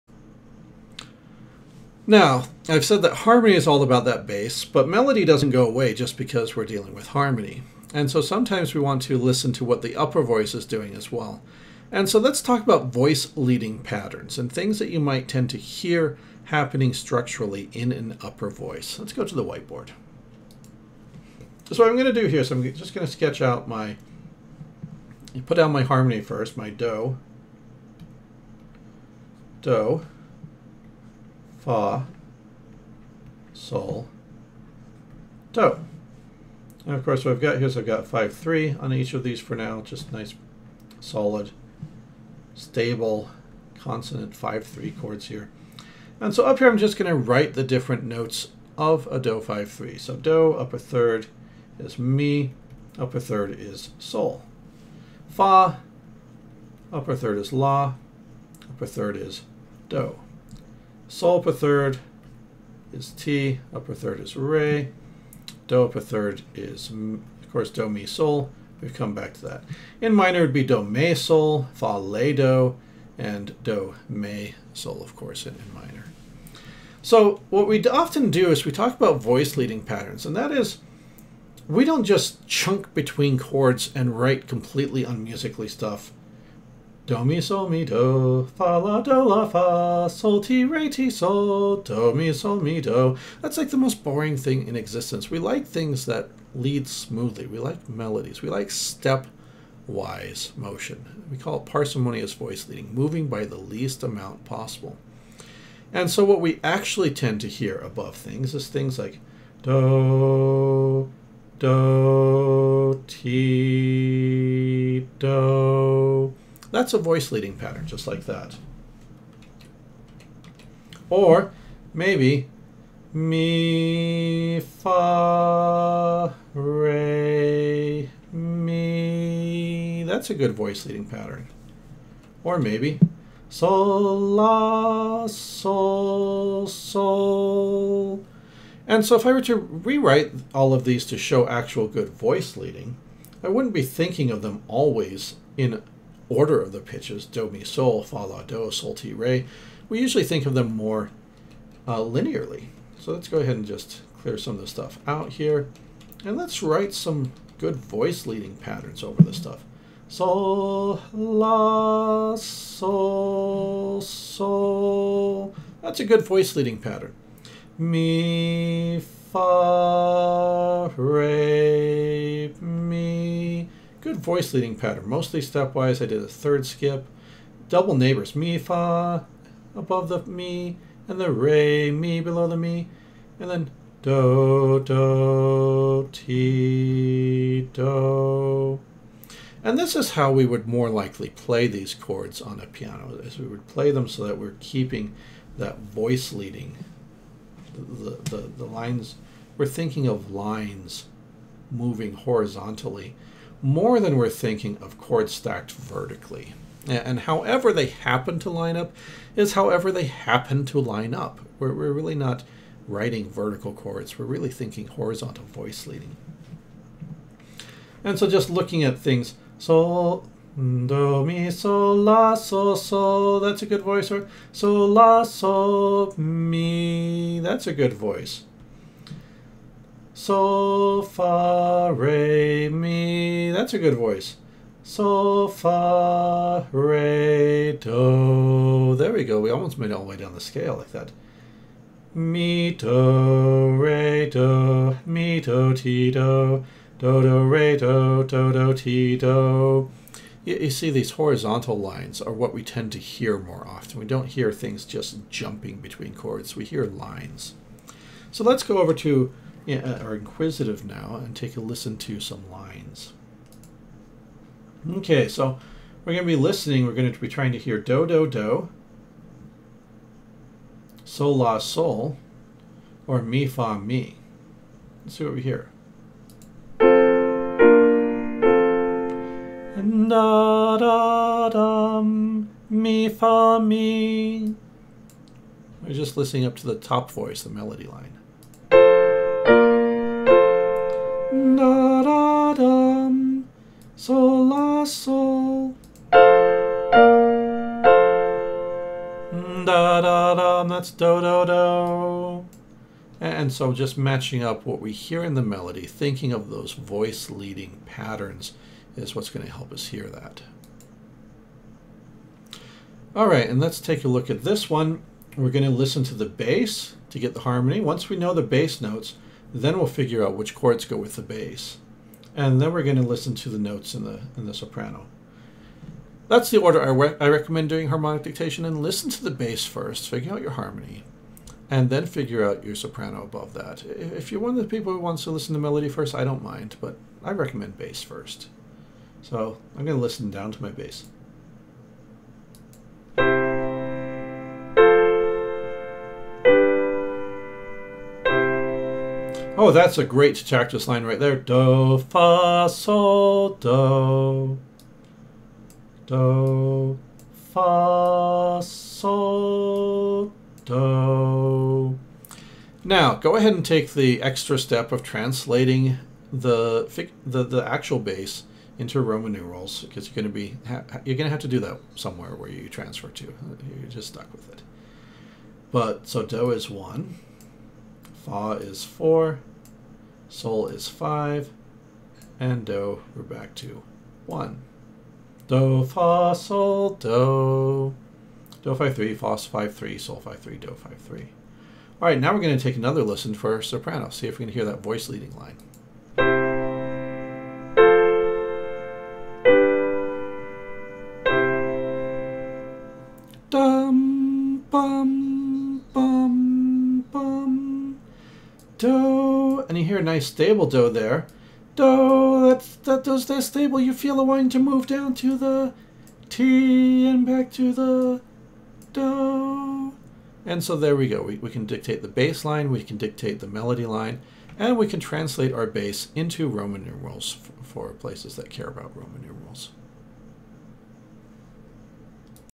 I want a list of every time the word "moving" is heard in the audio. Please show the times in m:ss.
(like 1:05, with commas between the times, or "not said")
1:42, 3:21.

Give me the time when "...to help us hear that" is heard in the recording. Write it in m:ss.
5:09.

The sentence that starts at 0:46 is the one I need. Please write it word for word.
And so up here I'm just going to write the different notes of a do 5-3.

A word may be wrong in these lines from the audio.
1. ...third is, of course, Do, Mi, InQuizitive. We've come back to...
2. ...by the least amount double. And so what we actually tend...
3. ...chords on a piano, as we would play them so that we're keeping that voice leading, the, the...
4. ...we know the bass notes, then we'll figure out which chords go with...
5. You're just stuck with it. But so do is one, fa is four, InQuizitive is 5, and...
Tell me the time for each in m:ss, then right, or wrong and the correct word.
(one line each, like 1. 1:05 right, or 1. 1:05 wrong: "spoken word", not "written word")
1. 1:05 wrong: "Sol", not "InQuizitive"
2. 1:43 wrong: "possible", not "double"
3. 3:11 right
4. 5:18 right
5. 6:13 wrong: "Sol", not "InQuizitive".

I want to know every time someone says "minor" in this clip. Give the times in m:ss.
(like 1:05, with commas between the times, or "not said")
1:10, 1:15.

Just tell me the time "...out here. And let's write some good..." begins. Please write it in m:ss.
2:35.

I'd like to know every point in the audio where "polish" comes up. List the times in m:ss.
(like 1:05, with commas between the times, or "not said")
not said.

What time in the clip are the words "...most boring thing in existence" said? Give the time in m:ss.
1:33.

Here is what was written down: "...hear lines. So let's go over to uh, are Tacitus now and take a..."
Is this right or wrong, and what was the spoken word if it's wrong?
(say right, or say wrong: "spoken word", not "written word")
wrong: "InQuizitive", not "Tacitus".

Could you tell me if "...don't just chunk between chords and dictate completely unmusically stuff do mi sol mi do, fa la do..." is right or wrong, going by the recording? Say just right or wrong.
wrong.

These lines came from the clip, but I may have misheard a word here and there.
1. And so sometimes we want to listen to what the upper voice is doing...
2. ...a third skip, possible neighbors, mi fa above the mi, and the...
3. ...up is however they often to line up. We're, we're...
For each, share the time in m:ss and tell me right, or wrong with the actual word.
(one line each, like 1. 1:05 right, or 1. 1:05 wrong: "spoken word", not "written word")
1. 0:07 right
2. 2:56 wrong: "double", not "possible"
3. 3:28 wrong: "happen", not "often".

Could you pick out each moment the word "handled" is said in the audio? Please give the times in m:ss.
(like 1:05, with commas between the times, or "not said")
not said.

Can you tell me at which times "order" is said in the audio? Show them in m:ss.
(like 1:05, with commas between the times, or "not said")
2:26, 5:26.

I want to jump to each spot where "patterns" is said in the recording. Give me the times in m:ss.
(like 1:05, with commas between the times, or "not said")
0:13, 1:19, 1:57, 2:11, 2:38, 2:46, 2:54, 5:07.